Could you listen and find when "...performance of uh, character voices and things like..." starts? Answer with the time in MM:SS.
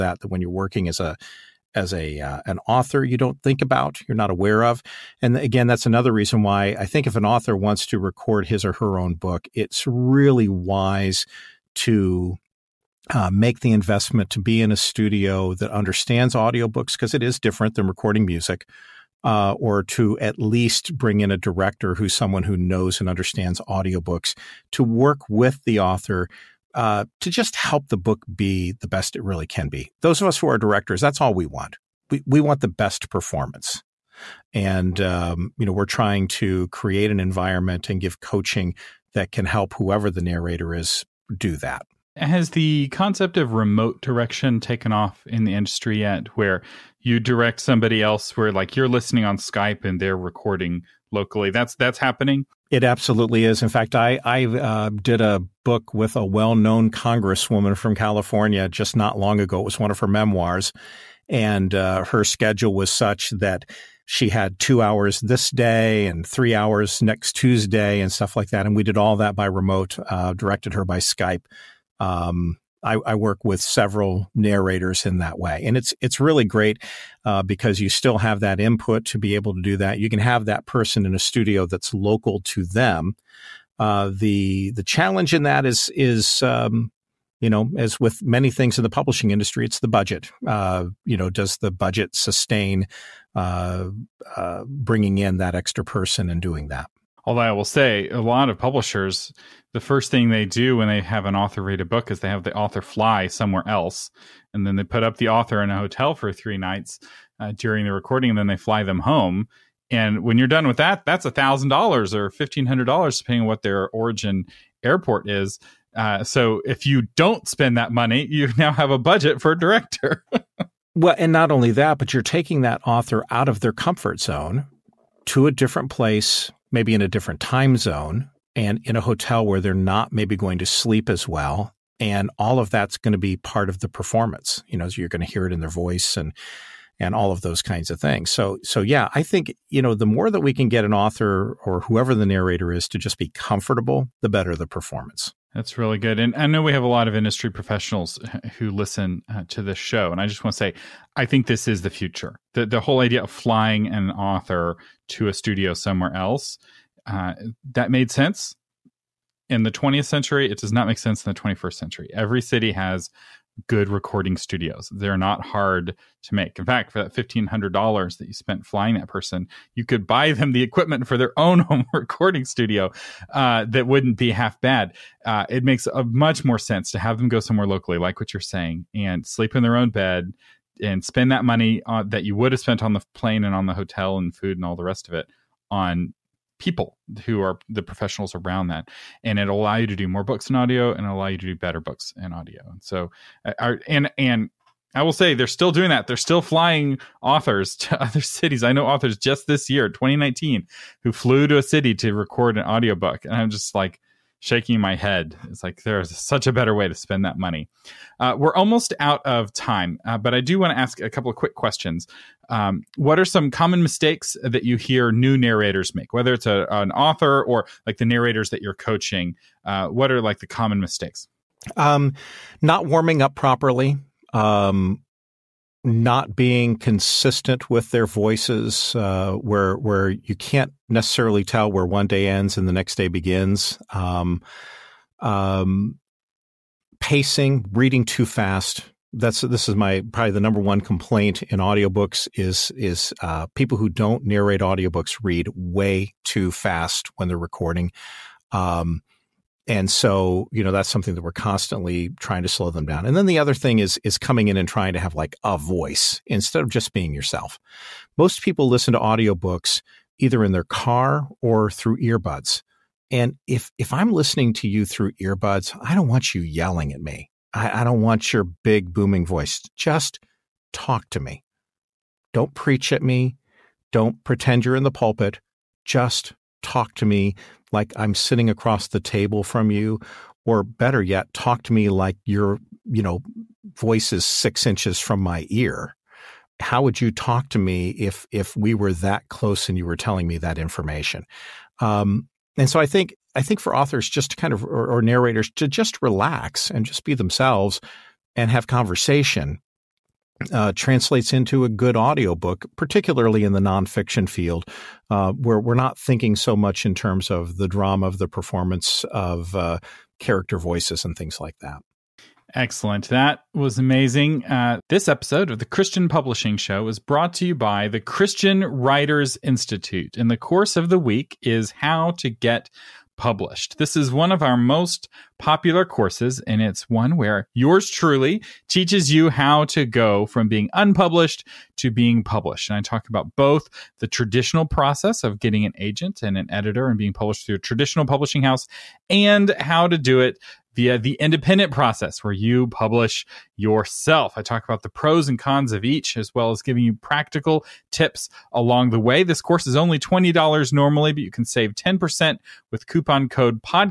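05:08.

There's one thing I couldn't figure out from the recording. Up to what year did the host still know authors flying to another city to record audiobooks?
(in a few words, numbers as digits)
2019.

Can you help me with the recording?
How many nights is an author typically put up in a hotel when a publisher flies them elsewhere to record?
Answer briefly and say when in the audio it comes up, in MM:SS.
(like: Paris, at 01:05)
three nights, at 01:46.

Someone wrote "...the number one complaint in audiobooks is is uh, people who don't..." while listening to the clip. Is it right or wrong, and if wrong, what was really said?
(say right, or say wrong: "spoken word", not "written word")
right.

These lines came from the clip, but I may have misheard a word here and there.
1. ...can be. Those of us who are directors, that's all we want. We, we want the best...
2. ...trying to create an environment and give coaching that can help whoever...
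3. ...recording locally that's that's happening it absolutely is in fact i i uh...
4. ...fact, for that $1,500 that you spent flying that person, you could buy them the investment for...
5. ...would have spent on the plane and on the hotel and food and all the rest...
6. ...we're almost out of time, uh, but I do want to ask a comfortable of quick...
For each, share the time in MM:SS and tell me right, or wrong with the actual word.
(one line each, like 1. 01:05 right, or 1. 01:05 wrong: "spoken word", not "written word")
1. 00:29 right
2. 00:35 right
3. 00:50 right
4. 02:46 wrong: "equipment", not "investment"
5. 03:02 right
6. 03:28 wrong: "couple", not "comfortable".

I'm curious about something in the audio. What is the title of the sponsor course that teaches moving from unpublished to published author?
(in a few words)
How to Get Published.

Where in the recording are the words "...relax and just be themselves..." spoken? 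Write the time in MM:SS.
04:56.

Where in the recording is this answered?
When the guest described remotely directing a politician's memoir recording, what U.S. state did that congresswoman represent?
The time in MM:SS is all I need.
00:57.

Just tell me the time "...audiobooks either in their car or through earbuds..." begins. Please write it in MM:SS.
04:18.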